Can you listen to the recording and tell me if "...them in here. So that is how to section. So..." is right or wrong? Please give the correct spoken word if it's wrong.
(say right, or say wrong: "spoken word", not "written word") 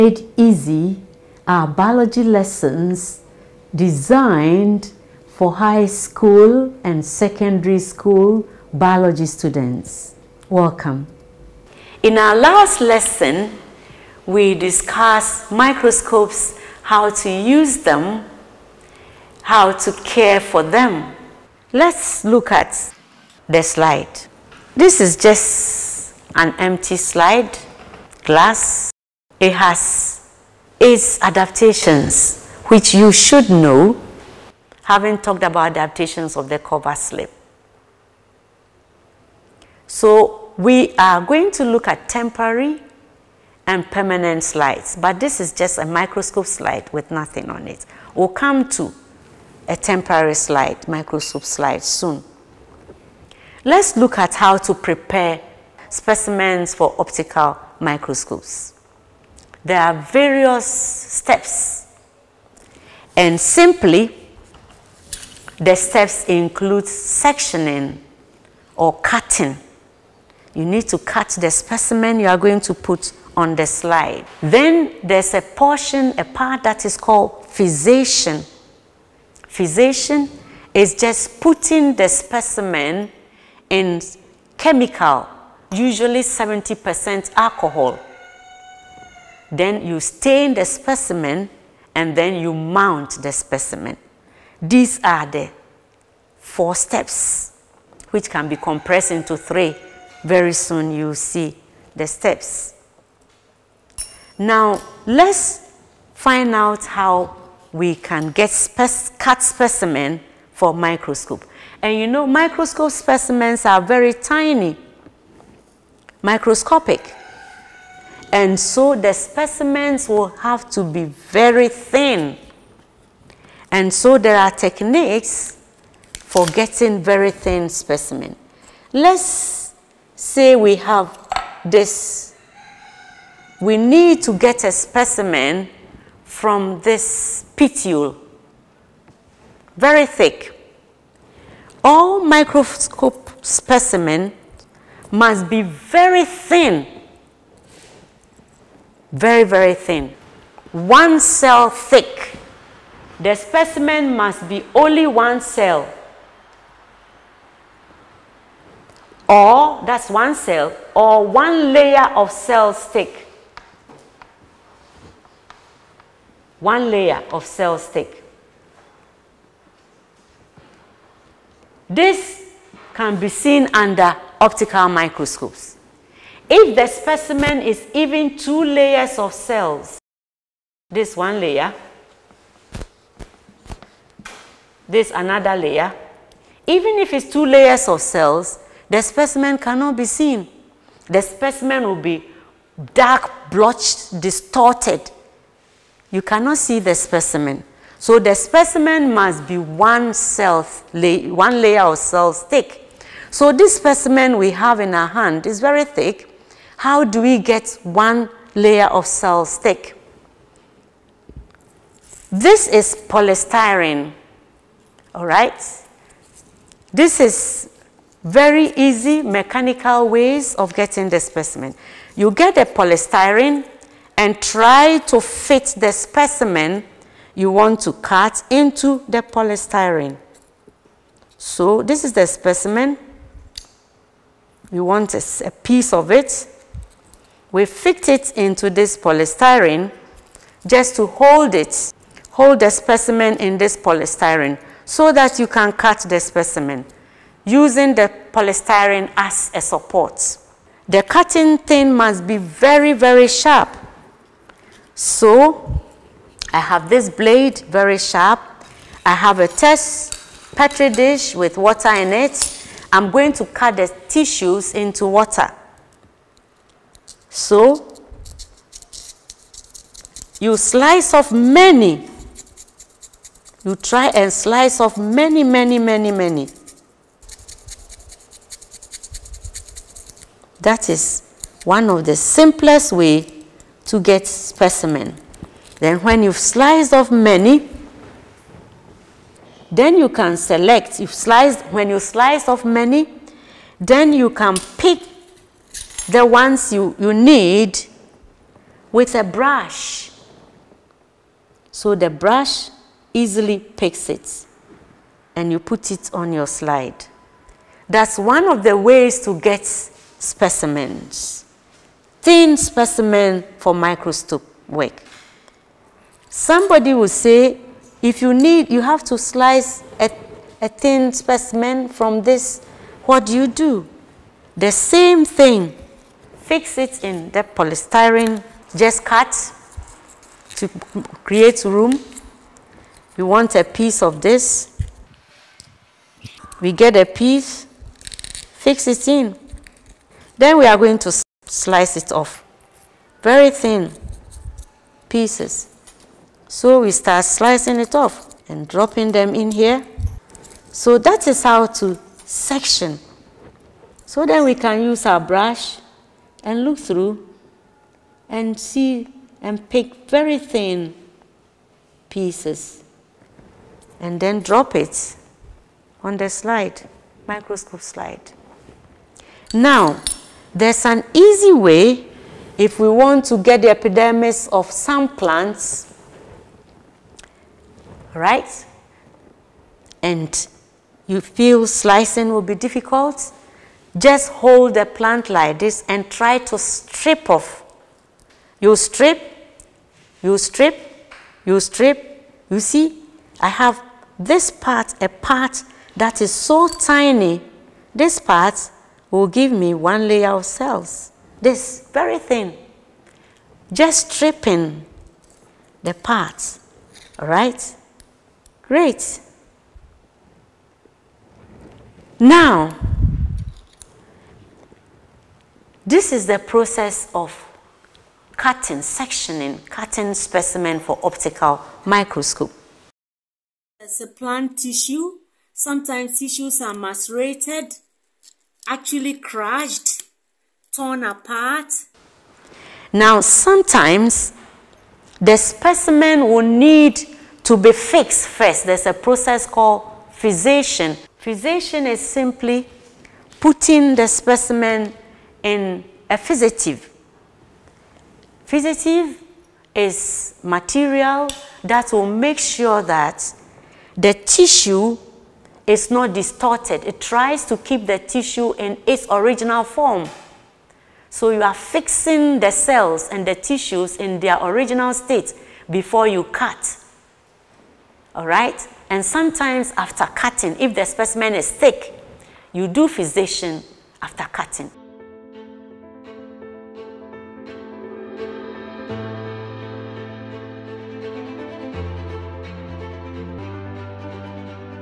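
right.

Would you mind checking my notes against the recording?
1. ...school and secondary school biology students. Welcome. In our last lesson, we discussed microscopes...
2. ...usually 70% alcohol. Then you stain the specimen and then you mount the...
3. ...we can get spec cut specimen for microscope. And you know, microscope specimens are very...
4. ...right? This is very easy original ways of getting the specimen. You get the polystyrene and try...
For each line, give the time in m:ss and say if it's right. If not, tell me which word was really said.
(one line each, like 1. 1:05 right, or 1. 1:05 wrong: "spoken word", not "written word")
1. 0:05 right
2. 1:25 right
3. 1:47 right
4. 3:35 wrong: "mechanical", not "original".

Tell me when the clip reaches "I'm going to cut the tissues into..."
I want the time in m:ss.
4:22.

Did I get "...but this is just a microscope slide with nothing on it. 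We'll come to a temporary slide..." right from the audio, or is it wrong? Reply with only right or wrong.
right.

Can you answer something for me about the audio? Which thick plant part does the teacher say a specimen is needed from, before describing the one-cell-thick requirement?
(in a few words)
Petiole.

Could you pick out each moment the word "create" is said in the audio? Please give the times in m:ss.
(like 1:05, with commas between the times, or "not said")
5:31.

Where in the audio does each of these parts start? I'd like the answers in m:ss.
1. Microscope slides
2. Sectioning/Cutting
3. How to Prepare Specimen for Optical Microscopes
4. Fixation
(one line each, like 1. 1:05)
1. 0:22
2. 3:45
3. 0:54
4. 7:19.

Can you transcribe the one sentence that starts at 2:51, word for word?
This can be seen under optical microscopes.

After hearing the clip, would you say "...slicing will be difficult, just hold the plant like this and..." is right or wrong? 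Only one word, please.
right.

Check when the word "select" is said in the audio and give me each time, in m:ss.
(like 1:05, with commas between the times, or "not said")
4:50.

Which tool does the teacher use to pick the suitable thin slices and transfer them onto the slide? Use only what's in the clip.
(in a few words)
A brush.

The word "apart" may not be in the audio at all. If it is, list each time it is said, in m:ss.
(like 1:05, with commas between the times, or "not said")
7:11.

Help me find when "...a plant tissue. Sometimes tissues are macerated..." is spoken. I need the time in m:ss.
7:04.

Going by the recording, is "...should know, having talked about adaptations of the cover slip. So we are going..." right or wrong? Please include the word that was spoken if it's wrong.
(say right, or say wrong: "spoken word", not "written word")
right.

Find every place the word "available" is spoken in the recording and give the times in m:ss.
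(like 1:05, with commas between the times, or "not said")
not said.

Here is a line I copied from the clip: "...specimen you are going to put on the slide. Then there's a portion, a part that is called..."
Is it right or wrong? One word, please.
right.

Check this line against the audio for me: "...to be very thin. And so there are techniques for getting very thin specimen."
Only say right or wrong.
right.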